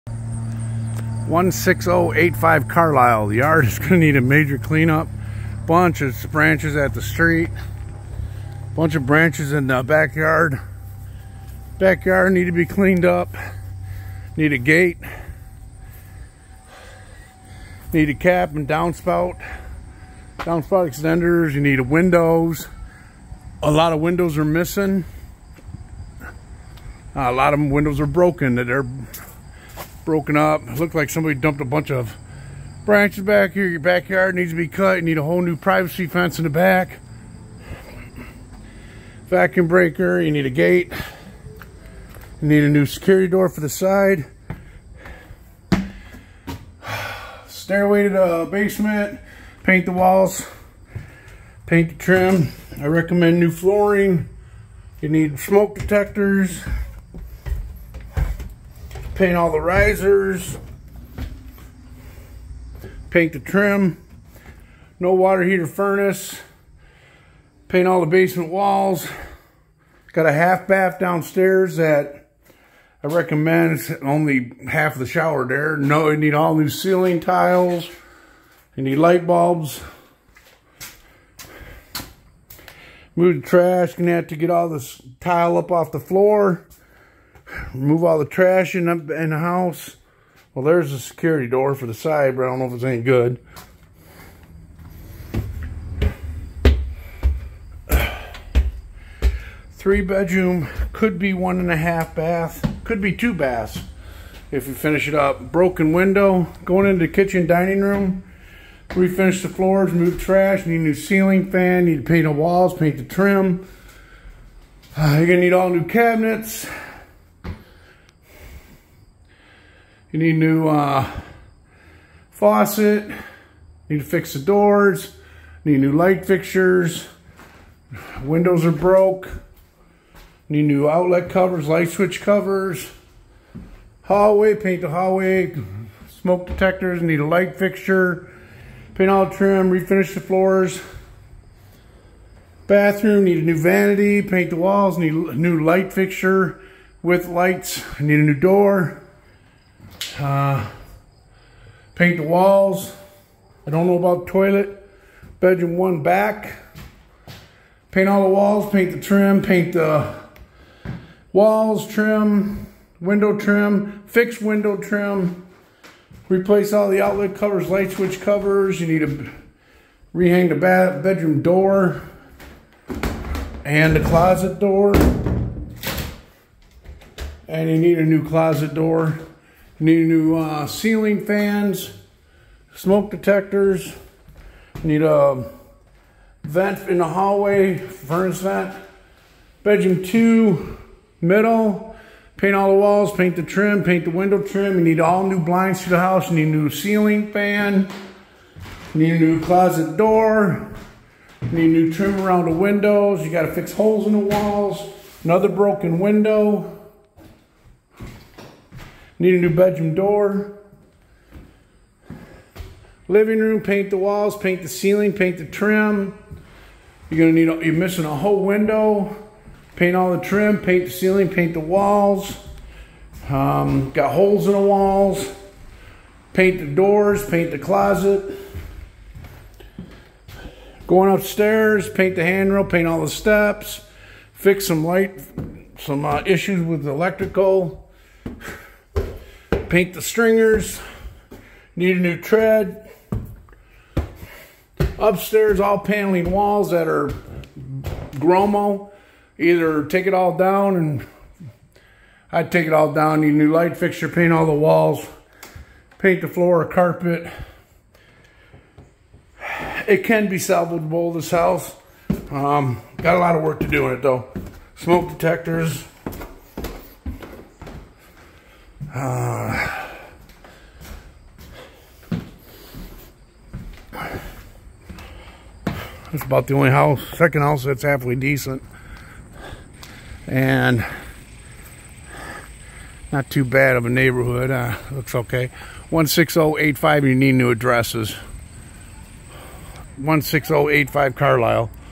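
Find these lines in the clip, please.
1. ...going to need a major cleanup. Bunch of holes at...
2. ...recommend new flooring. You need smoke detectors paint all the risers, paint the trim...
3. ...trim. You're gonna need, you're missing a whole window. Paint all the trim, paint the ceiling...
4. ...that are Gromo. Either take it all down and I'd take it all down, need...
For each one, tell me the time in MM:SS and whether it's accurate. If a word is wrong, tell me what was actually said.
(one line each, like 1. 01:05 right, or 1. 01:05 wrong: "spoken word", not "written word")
1. 00:03 wrong: "branches", not "holes"
2. 00:52 right
3. 03:35 right
4. 04:06 right.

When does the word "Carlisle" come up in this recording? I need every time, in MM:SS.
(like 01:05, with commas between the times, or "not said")
00:02, 04:51.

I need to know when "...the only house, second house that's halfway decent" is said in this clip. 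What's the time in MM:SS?
04:36.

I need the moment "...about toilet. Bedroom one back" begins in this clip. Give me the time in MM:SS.
02:33.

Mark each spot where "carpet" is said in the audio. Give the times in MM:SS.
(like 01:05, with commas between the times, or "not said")
04:16.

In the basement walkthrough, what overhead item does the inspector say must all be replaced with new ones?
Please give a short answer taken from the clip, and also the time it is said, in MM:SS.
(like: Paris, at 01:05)
Ceiling tiles, at 01:16.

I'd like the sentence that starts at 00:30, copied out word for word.
It looked like somebody dumped a bunch of branches back here.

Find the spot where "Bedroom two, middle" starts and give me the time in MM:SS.
03:09.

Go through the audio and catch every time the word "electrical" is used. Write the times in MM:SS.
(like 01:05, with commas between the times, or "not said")
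03:56.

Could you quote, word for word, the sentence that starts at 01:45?
Broken window, going into the kitchen, dining room.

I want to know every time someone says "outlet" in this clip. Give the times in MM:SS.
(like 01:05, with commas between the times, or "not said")
02:10, 02:47.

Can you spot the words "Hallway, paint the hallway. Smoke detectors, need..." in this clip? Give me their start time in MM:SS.
02:14.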